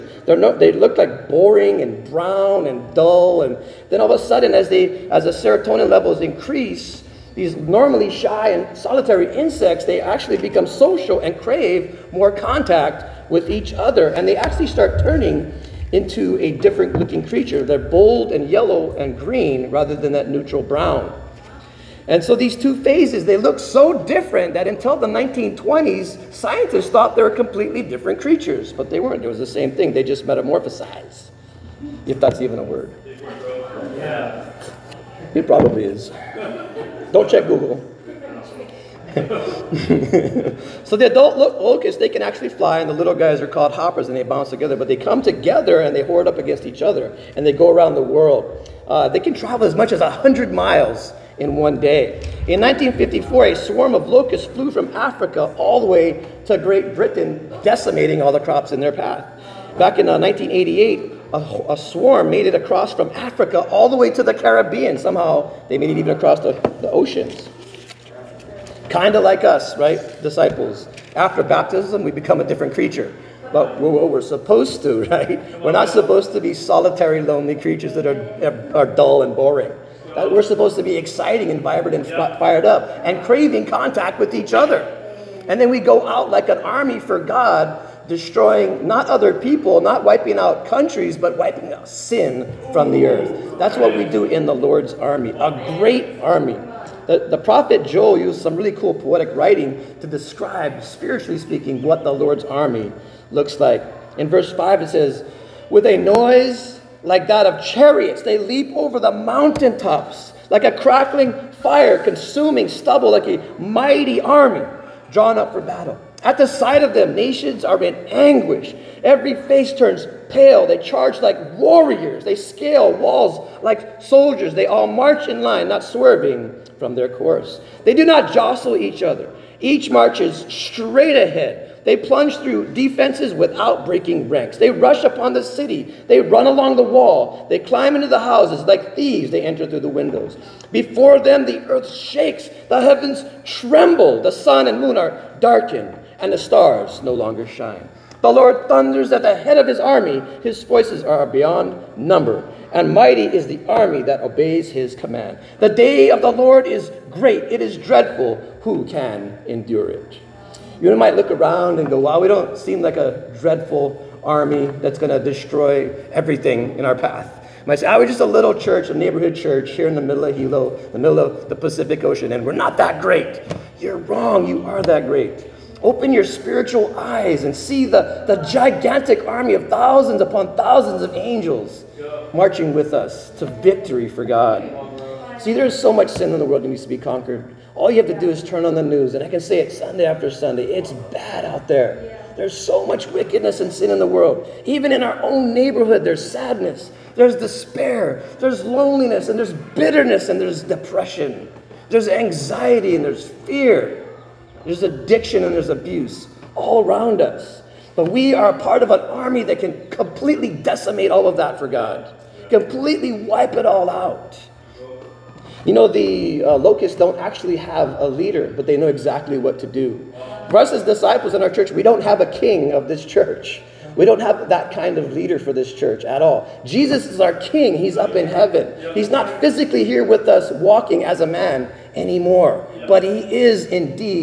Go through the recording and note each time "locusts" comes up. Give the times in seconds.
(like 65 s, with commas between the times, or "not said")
41 s, 54 s, 216 s.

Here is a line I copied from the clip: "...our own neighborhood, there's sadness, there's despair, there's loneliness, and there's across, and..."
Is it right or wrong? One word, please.
wrong.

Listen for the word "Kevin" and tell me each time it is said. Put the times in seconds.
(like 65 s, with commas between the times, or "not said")
not said.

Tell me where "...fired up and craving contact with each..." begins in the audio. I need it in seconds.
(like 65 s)
82 s.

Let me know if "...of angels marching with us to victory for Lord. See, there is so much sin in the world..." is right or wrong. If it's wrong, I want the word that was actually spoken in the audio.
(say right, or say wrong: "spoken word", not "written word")
wrong: "God", not "Lord".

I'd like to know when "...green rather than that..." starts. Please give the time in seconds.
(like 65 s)
19 s.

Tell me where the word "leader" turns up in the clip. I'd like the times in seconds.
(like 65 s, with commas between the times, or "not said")
218 s, 225 s.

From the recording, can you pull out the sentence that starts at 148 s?
The Lord thunders at the head of his army.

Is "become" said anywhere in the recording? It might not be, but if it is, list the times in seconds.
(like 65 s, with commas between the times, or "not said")
10 s, 72 s.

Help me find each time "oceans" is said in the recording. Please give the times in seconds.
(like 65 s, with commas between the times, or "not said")
66 s, 172 s.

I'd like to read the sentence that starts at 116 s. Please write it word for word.
At the sight of them, nations are in anguish.